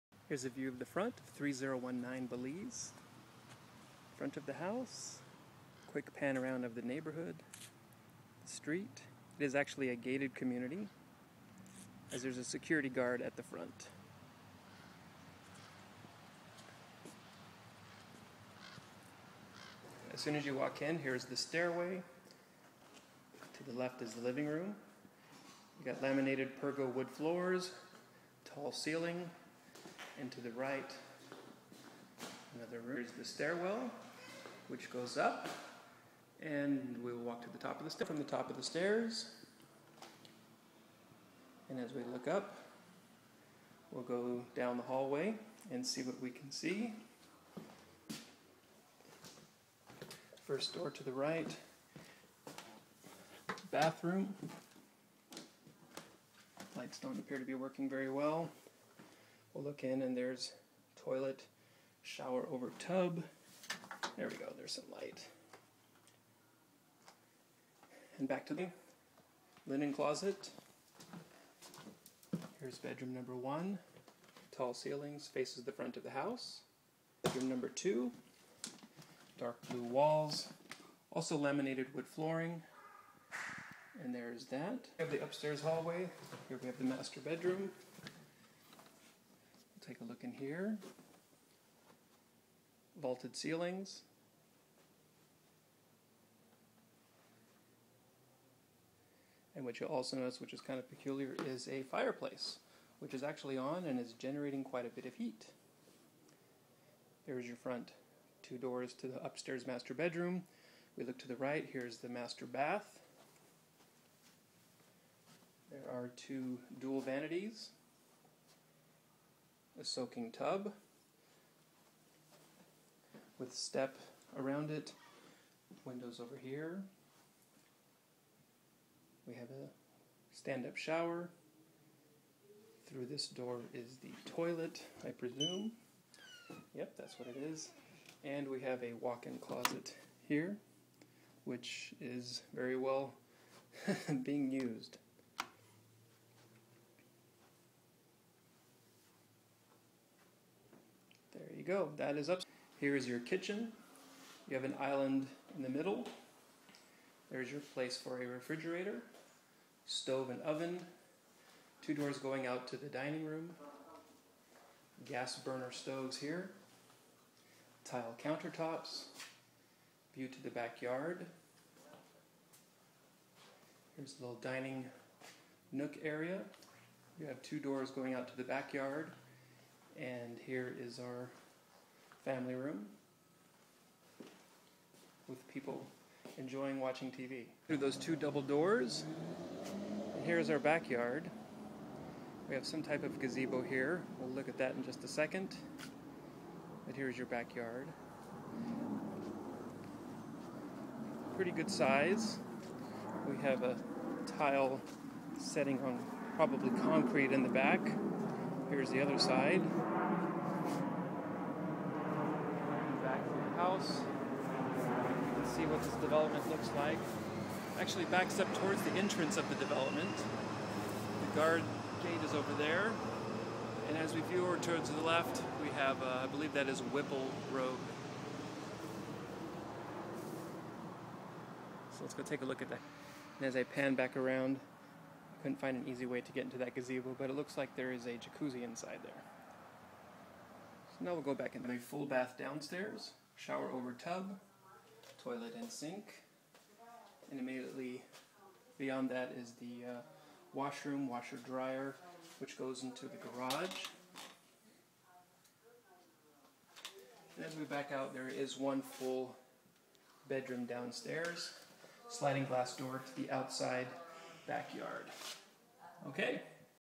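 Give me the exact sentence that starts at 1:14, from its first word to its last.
Tall ceilings faces the front of the house.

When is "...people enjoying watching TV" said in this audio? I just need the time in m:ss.
3:05.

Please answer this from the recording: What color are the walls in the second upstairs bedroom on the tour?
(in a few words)
Dark blue.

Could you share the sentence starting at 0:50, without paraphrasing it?
First door to the right, bathroom.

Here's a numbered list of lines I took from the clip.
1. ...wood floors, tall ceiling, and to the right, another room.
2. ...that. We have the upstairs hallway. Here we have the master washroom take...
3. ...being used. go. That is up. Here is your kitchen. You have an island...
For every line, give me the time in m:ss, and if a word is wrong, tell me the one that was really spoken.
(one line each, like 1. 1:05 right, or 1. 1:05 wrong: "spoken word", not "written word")
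1. 0:26 right
2. 1:24 wrong: "bedroom", not "washroom"
3. 2:24 right.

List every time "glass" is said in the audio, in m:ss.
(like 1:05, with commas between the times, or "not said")
4:22.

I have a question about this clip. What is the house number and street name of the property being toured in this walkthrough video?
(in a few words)
3019 Belize.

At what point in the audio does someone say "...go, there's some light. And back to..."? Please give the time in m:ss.
1:04.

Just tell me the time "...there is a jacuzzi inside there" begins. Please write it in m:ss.
3:57.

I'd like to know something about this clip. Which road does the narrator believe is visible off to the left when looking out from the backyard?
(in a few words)
Whipple Road.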